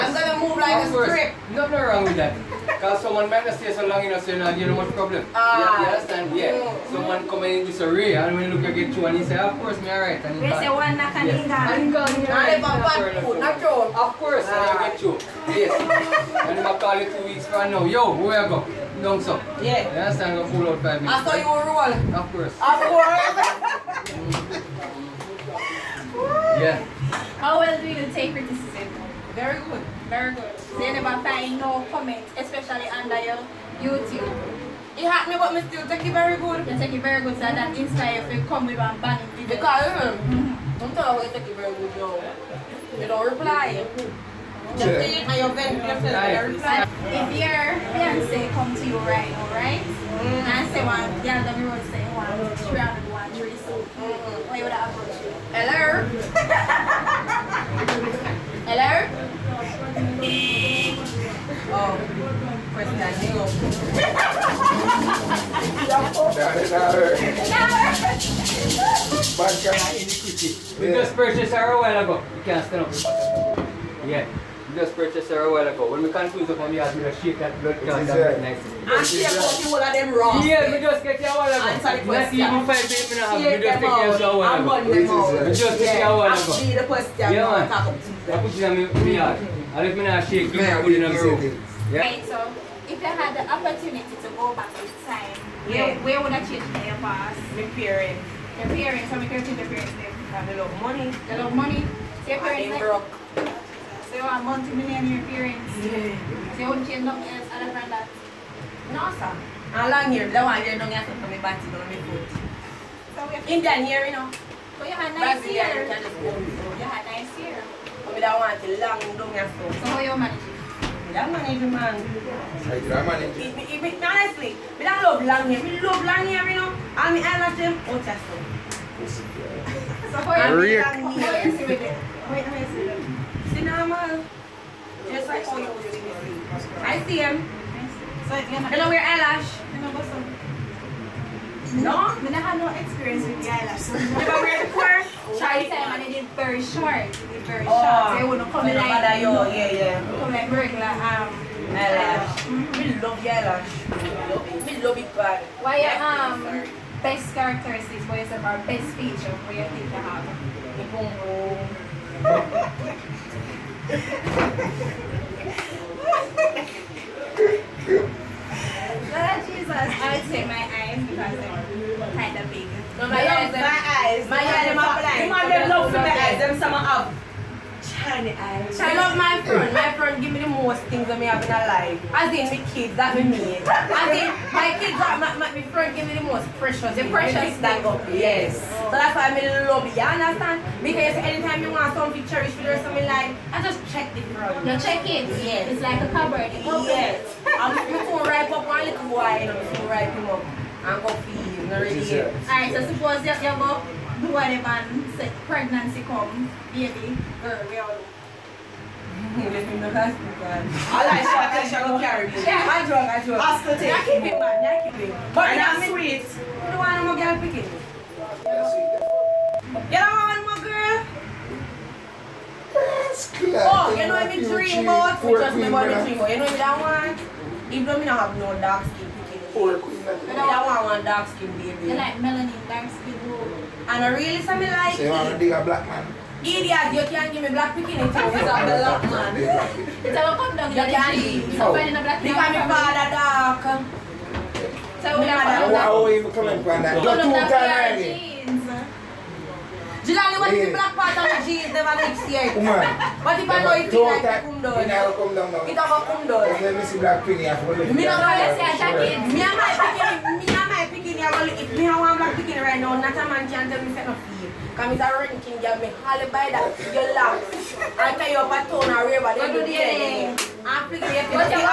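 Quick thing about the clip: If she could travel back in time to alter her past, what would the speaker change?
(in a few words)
My parents.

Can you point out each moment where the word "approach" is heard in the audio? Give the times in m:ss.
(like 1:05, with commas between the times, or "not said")
0:54.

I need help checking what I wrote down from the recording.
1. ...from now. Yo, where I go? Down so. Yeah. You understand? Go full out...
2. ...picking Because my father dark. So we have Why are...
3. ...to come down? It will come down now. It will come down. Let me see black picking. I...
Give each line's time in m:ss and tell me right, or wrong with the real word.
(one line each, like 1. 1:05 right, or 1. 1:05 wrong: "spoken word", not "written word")
1. 0:17 right
2. 4:02 right
3. 4:14 right.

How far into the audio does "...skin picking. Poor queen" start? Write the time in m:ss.
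3:48.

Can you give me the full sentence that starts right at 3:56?
Idiot, you can't give me black picking it out without the lock, man.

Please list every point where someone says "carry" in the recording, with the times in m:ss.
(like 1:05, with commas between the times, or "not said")
3:32, 4:28.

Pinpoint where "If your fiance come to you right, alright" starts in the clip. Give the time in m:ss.
0:44.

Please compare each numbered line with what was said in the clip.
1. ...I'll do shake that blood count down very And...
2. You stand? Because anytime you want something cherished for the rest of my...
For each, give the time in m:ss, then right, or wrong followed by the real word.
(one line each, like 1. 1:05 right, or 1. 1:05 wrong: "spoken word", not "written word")
1. 1:16 right
2. 3:09 wrong: "understand", not "stand".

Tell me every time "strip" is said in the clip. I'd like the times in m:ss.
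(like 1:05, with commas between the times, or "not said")
0:01.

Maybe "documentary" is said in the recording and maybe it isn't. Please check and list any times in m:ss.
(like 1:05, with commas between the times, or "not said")
not said.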